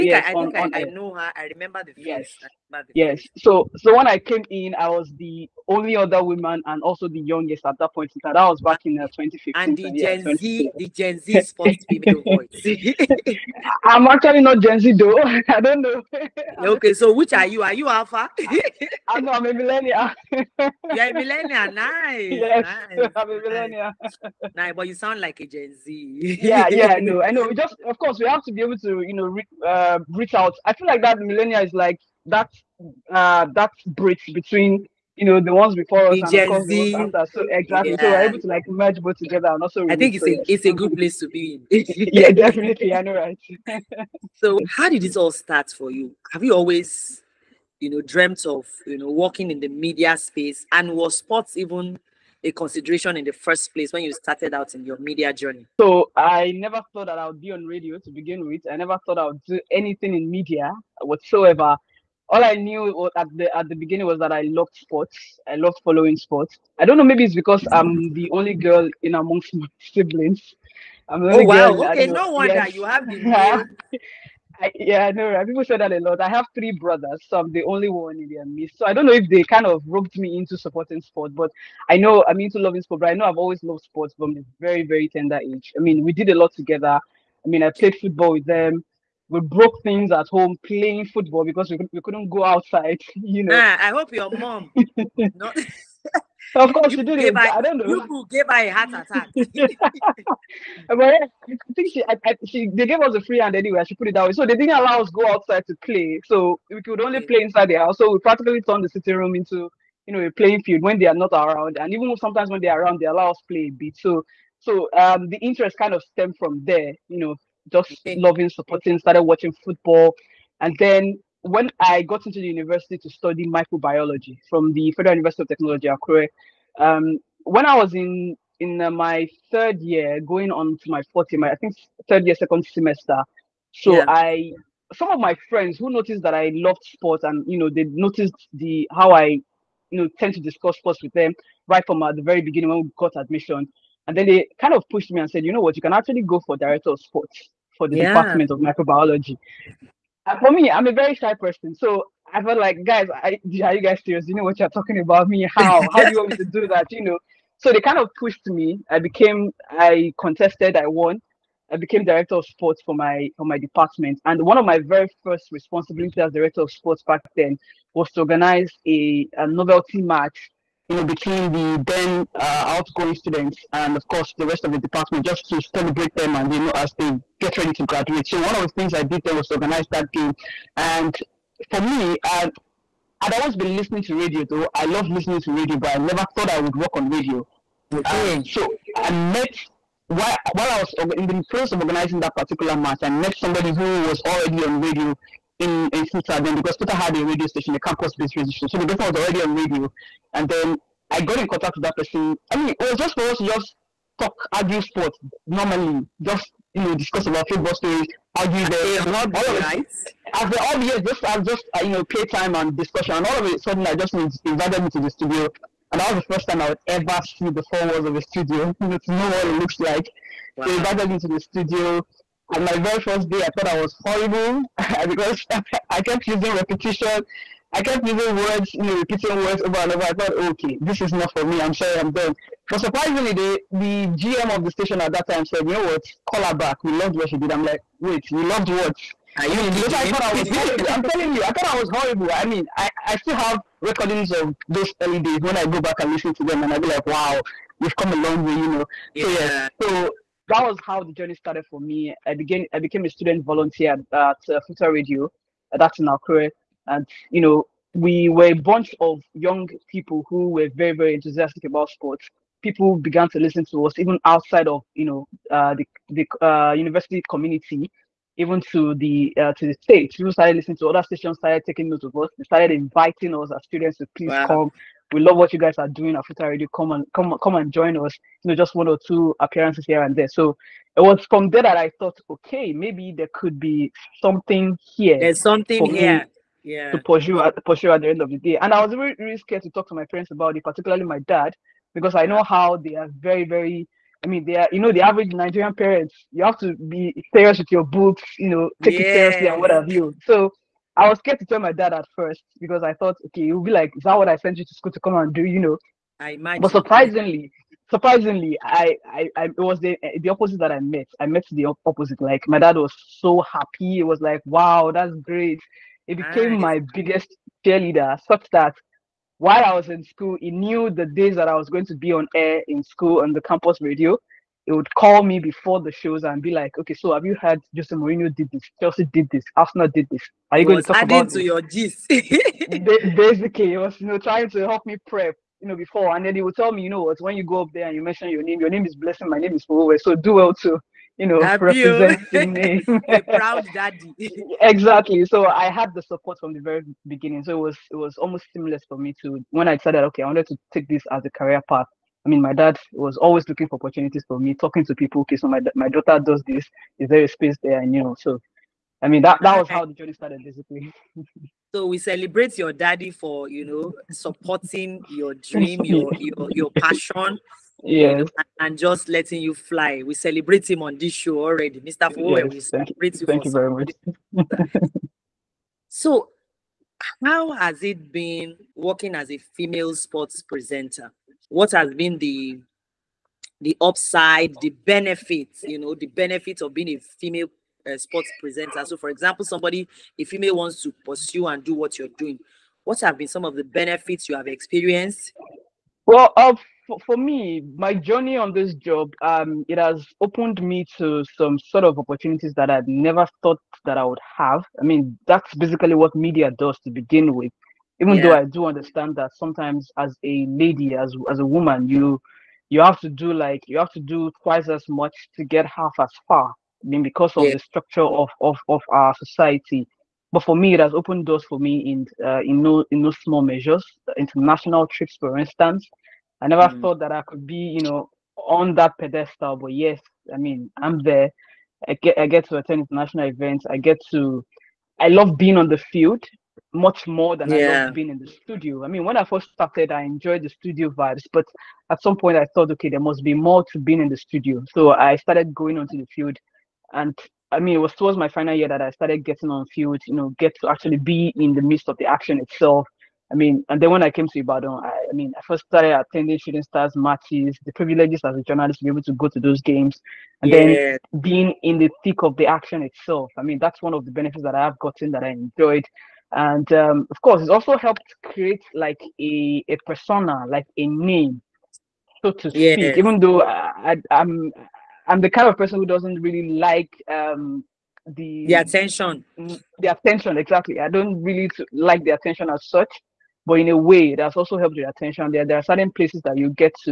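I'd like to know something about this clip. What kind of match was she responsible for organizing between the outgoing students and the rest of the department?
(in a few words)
Novelty match.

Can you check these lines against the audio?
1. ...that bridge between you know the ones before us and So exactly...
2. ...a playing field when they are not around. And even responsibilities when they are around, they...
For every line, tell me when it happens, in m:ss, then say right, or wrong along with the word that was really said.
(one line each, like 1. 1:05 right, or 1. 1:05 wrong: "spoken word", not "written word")
1. 0:33 right
2. 1:50 wrong: "sometimes", not "responsibilities".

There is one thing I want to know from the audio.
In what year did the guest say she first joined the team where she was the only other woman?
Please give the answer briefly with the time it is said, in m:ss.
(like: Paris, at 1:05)
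2015, at 0:09.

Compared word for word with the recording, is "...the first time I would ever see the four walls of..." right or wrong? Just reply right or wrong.
right.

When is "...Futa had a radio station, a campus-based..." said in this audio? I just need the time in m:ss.
3:16.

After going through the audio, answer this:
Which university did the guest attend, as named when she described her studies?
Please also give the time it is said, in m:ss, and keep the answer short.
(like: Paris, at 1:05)
Federal University of Technology, Akure, at 2:04.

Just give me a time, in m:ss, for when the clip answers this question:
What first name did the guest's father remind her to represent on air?
5:38.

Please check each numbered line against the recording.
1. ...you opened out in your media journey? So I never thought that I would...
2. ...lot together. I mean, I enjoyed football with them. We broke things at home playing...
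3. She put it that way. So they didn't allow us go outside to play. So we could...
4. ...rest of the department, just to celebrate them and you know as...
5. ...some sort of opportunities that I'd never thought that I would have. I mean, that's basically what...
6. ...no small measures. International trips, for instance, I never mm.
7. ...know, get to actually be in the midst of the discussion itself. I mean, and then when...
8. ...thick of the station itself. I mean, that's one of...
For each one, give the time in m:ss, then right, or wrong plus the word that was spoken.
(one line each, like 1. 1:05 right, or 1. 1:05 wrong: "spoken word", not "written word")
1. 0:54 wrong: "started", not "opened"
2. 1:26 wrong: "played", not "enjoyed"
3. 1:43 right
4. 2:54 right
5. 6:41 right
6. 7:03 right
7. 7:30 wrong: "action", not "discussion"
8. 7:42 wrong: "action", not "station".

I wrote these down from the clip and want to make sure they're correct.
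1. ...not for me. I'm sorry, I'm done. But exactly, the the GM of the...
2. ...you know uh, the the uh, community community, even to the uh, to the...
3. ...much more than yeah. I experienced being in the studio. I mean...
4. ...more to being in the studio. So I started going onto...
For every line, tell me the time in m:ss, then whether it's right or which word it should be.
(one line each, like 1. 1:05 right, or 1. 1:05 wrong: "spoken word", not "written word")
1. 3:51 wrong: "surprisingly", not "exactly"
2. 4:24 wrong: "university", not "community"
3. 7:16 wrong: "loved", not "experienced"
4. 7:23 right.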